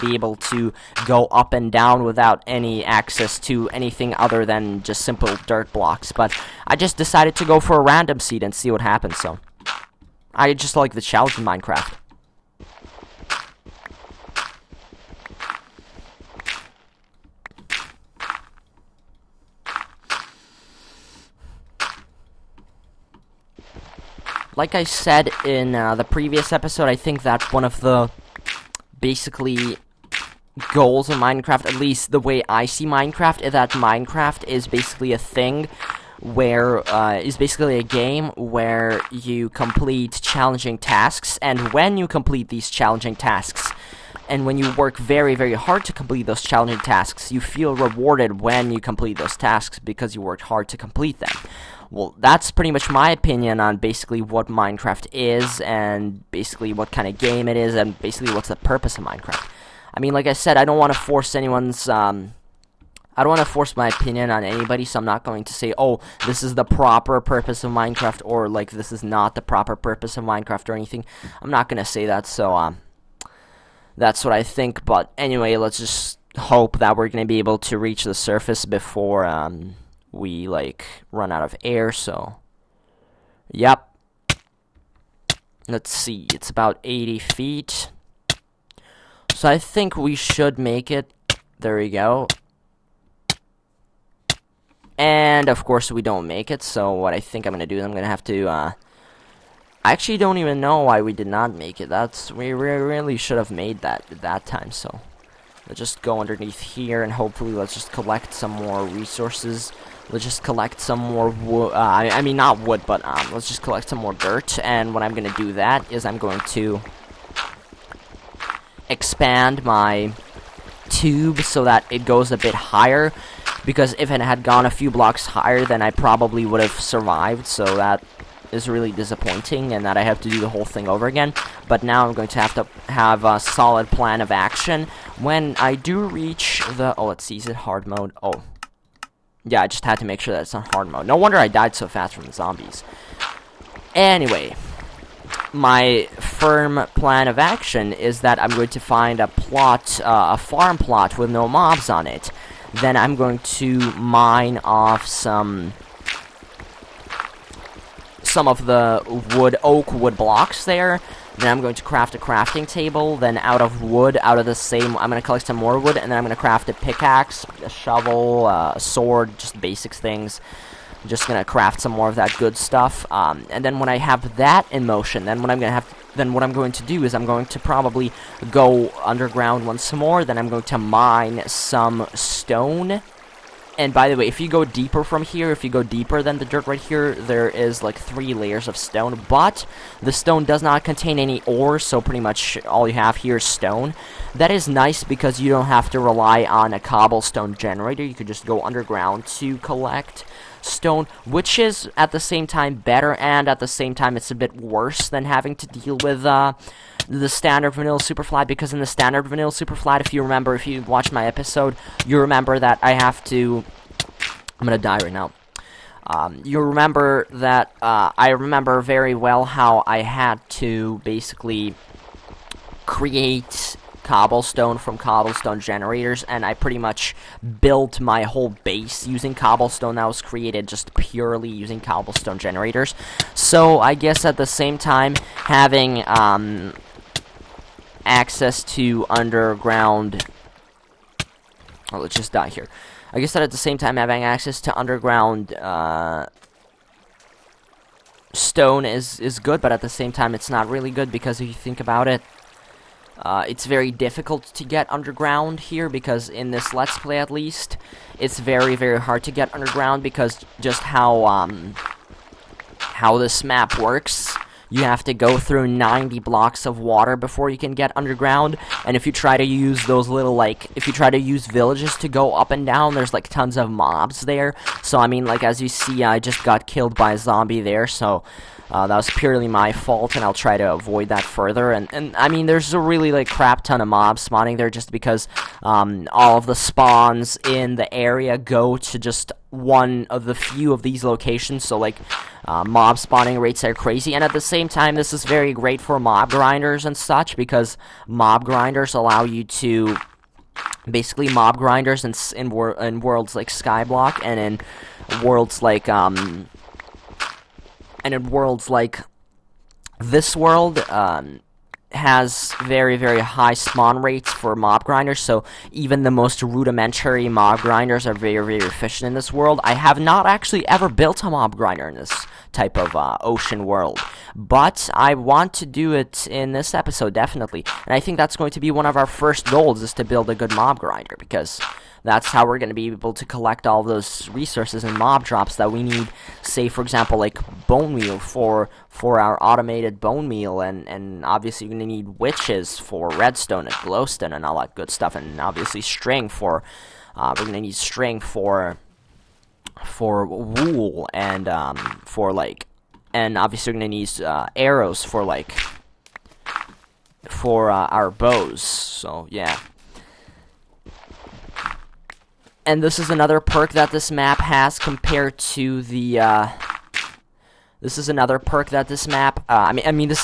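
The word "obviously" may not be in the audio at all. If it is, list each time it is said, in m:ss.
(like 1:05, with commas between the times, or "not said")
5:41, 5:45, 5:53.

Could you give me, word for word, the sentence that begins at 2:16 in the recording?
Oh, let's see, is it hard mode?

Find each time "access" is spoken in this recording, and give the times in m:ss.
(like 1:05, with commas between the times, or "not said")
0:02, 3:58, 4:04.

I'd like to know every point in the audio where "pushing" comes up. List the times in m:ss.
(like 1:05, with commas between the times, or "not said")
not said.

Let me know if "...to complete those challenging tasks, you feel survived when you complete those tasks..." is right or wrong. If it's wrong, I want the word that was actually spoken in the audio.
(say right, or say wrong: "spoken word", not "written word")
wrong: "rewarded", not "survived".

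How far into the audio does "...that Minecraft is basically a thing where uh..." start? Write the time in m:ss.
0:33.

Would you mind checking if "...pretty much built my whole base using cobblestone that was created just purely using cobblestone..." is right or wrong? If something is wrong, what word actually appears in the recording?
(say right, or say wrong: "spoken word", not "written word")
right.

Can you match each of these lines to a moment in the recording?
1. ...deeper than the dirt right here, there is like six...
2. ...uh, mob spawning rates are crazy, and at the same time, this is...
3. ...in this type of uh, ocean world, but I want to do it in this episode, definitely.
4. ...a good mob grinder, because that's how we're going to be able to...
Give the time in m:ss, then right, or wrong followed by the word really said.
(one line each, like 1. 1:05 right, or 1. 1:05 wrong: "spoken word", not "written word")
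1. 3:05 wrong: "three", not "six"
2. 4:52 right
3. 5:21 right
4. 5:30 right.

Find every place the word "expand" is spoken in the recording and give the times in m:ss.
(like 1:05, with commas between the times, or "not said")
1:58.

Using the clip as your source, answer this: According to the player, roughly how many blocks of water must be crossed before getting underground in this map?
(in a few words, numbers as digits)
90.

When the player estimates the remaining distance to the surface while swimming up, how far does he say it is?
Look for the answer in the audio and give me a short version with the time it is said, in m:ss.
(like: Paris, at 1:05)
80 feet, at 1:26.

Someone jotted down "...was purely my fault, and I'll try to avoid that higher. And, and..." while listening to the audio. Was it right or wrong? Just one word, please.
wrong.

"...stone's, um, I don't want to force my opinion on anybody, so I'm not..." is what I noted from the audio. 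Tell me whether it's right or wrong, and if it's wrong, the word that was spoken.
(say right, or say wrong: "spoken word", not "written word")
wrong: "anyone", not "stone".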